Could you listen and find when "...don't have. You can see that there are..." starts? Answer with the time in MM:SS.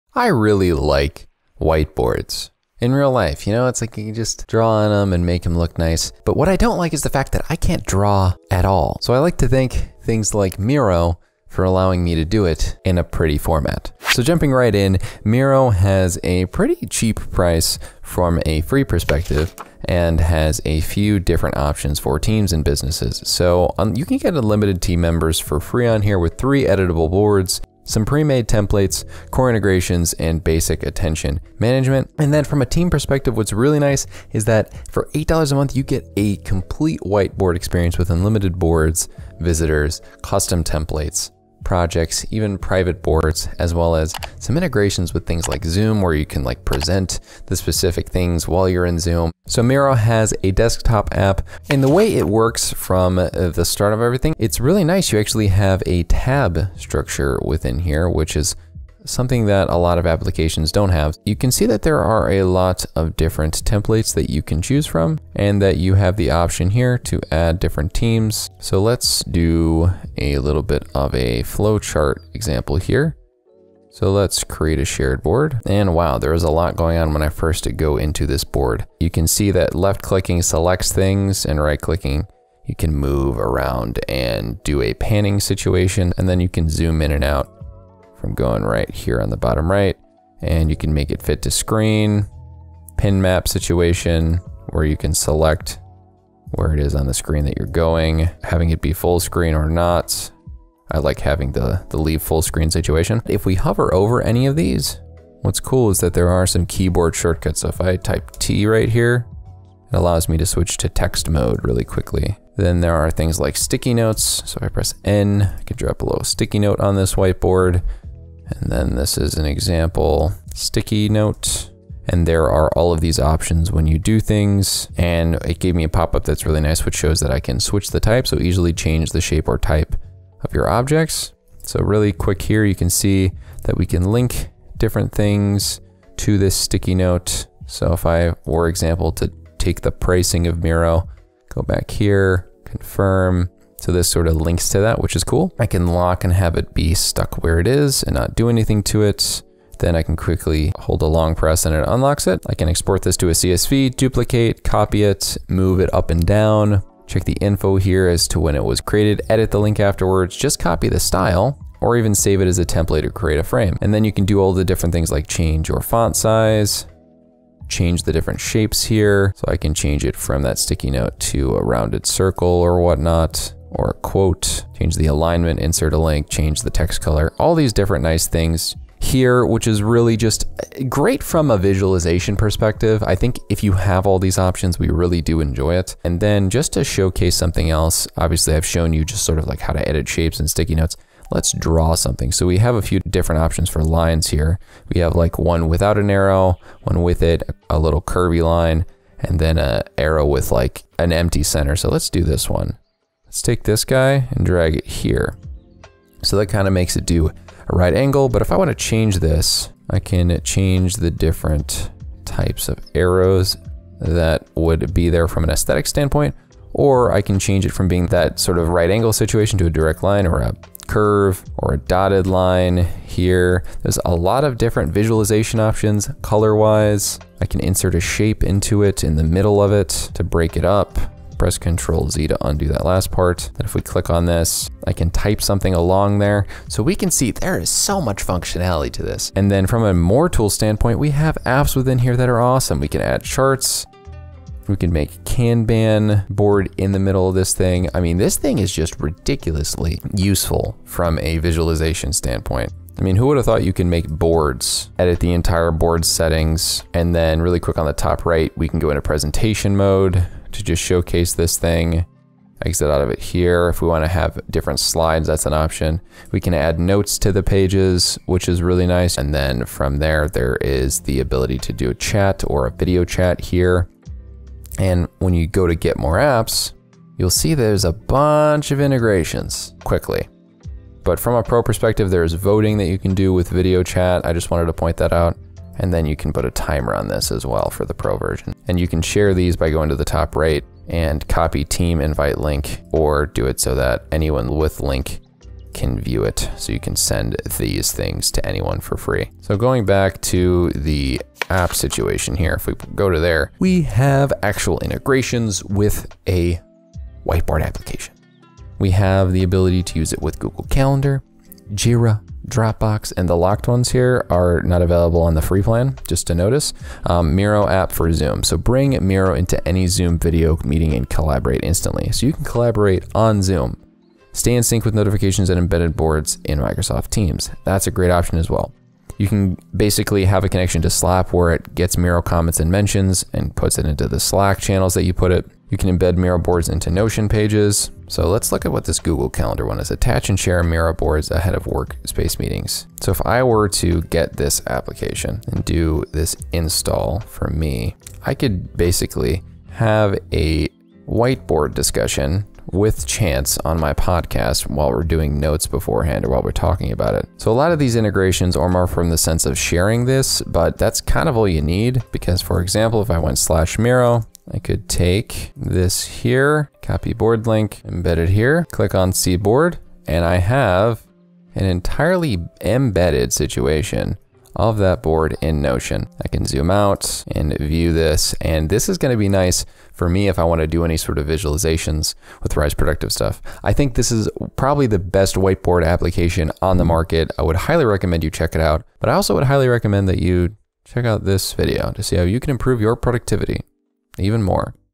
01:00.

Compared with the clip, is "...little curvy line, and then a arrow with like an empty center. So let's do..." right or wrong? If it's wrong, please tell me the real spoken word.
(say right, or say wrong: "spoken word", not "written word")
right.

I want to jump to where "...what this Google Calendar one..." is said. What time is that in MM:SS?
05:38.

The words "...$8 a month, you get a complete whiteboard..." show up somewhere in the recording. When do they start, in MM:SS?
00:35.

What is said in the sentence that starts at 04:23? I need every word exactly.
If we wanna have different slides, that's an option.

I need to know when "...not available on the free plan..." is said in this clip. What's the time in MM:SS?
05:14.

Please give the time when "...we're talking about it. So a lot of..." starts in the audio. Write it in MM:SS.
05:56.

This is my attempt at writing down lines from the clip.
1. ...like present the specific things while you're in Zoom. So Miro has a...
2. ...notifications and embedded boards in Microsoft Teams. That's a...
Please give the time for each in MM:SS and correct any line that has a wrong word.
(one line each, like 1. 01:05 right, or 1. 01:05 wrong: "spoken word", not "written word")
1. 00:46 right
2. 05:24 right.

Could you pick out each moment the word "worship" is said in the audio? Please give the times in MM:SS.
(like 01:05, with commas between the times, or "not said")
not said.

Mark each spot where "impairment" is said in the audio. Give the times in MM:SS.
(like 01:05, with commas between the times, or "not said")
not said.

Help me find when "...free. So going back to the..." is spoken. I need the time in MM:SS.
04:58.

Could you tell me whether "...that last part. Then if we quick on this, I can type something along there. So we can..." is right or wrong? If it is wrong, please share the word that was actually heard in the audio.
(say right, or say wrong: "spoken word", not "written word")
wrong: "click", not "quick".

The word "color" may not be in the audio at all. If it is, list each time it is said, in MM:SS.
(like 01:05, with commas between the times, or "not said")
02:57, 03:46.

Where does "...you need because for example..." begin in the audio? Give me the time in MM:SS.
06:01.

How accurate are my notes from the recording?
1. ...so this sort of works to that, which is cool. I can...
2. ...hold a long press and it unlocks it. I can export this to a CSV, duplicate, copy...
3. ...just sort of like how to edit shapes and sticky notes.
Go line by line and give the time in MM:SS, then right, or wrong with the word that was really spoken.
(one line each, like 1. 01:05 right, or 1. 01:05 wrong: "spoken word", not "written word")
1. 02:23 wrong: "links", not "works"
2. 02:30 right
3. 03:09 right.